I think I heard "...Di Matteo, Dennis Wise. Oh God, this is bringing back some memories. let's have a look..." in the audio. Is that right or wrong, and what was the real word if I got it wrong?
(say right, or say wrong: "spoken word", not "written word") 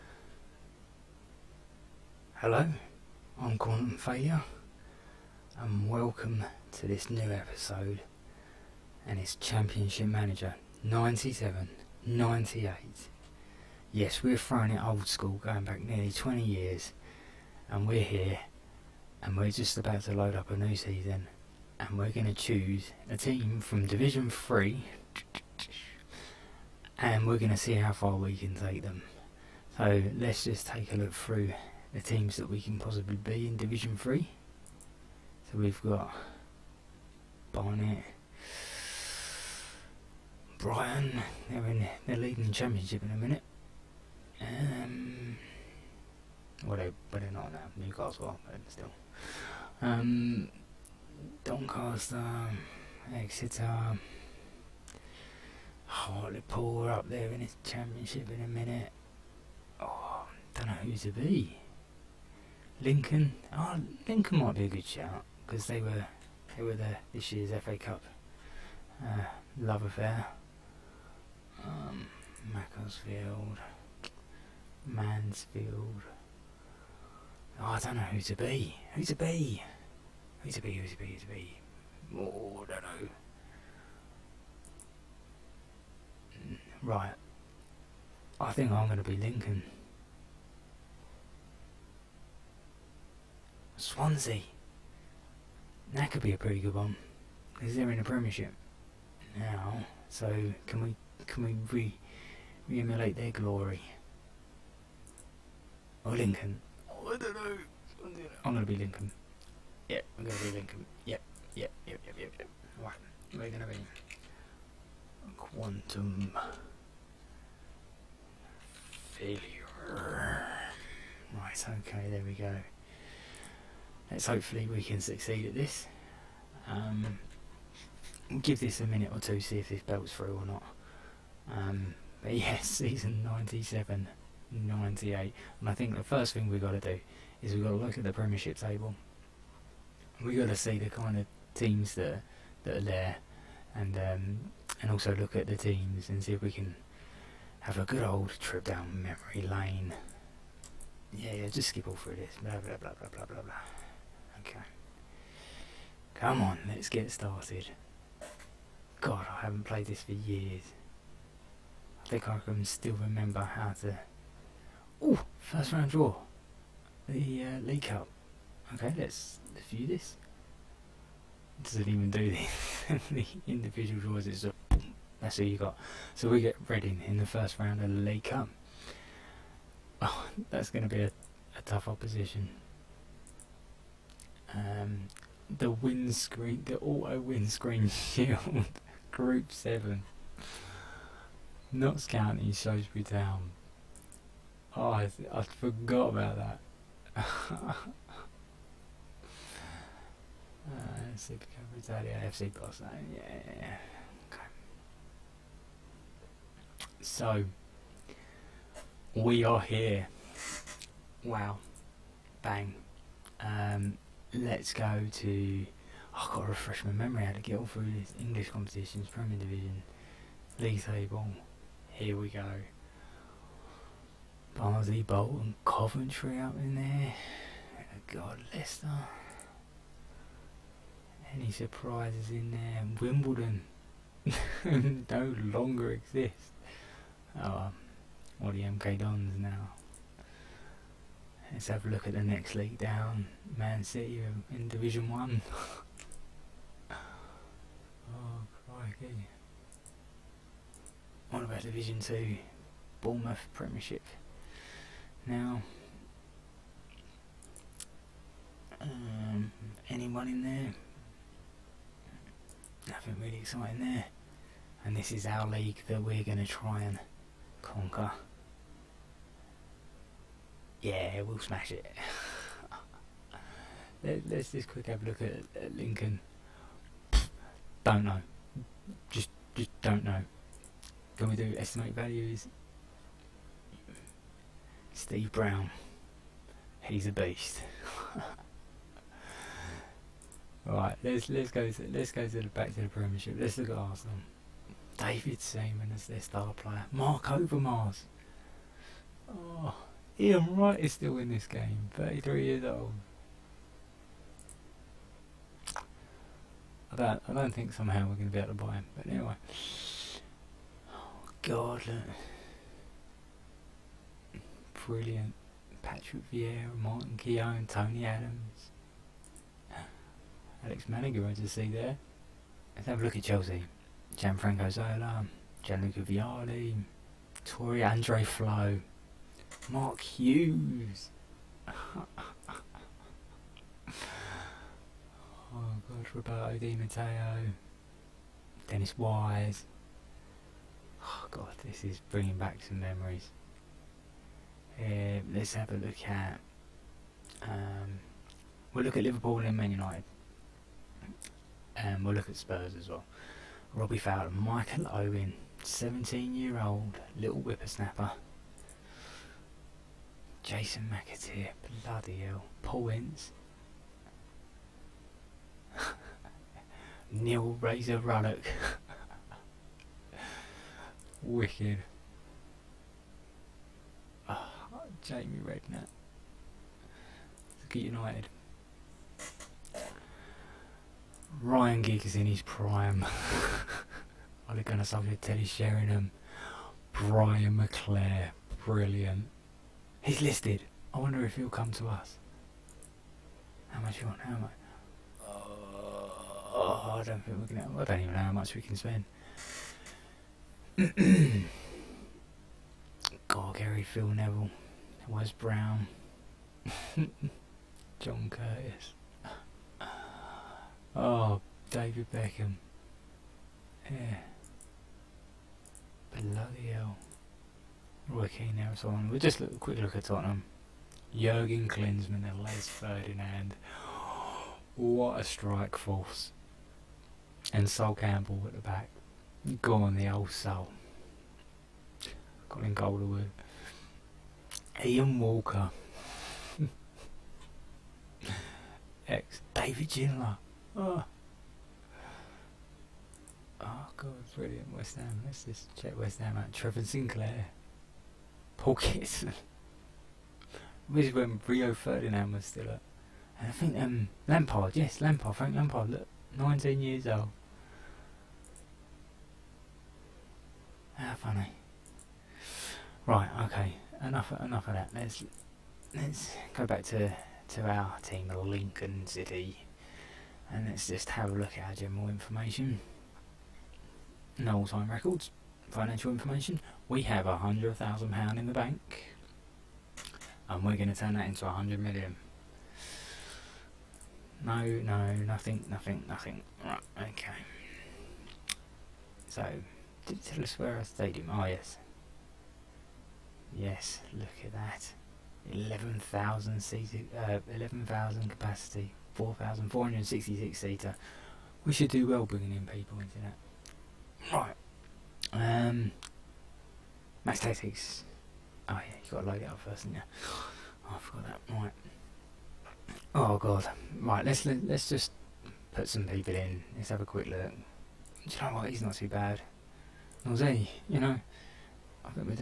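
right.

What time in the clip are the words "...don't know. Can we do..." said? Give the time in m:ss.
4:39.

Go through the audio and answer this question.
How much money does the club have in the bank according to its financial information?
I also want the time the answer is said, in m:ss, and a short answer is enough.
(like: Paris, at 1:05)
£100,000, at 7:57.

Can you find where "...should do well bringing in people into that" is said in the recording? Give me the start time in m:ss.
8:21.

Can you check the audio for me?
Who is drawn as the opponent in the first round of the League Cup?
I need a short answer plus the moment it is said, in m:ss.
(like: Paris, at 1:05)
Reading, at 2:56.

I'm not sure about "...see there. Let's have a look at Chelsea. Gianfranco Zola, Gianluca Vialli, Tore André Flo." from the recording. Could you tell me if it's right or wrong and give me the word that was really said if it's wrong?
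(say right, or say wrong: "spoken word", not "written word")
right.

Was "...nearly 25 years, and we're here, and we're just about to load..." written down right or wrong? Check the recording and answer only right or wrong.
wrong.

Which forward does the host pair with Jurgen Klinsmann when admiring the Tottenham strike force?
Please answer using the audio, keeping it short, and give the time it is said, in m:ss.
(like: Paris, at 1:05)
Les Ferdinand, at 7:02.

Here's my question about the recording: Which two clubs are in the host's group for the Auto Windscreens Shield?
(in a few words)
Notts County, Shrewsbury Town.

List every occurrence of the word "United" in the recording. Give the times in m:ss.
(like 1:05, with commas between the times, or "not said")
5:49, 6:17.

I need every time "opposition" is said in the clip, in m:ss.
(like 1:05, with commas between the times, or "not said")
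3:01.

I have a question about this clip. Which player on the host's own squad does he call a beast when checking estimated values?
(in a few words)
Steve Brown.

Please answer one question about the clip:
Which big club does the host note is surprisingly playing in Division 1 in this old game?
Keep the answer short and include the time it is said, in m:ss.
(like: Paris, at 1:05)
Man City, at 4:03.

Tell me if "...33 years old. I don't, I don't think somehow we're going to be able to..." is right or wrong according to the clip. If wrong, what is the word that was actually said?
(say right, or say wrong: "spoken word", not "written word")
right.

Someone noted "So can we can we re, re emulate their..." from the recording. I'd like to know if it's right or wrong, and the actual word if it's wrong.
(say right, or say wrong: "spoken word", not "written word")
right.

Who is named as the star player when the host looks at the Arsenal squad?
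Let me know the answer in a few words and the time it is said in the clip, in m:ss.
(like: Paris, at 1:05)
David Seaman, at 4:54.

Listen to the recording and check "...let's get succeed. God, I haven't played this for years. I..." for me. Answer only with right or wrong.
wrong.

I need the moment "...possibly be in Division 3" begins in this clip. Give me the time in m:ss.
0:32.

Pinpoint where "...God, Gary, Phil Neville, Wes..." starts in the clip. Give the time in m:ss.
6:43.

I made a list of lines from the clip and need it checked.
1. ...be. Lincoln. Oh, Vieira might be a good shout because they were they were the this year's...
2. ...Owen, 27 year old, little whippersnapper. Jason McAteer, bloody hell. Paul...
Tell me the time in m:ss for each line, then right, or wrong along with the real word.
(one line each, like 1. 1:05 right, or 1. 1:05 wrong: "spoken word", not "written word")
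1. 1:01 wrong: "Lincoln", not "Vieira"
2. 5:54 wrong: "17", not "27".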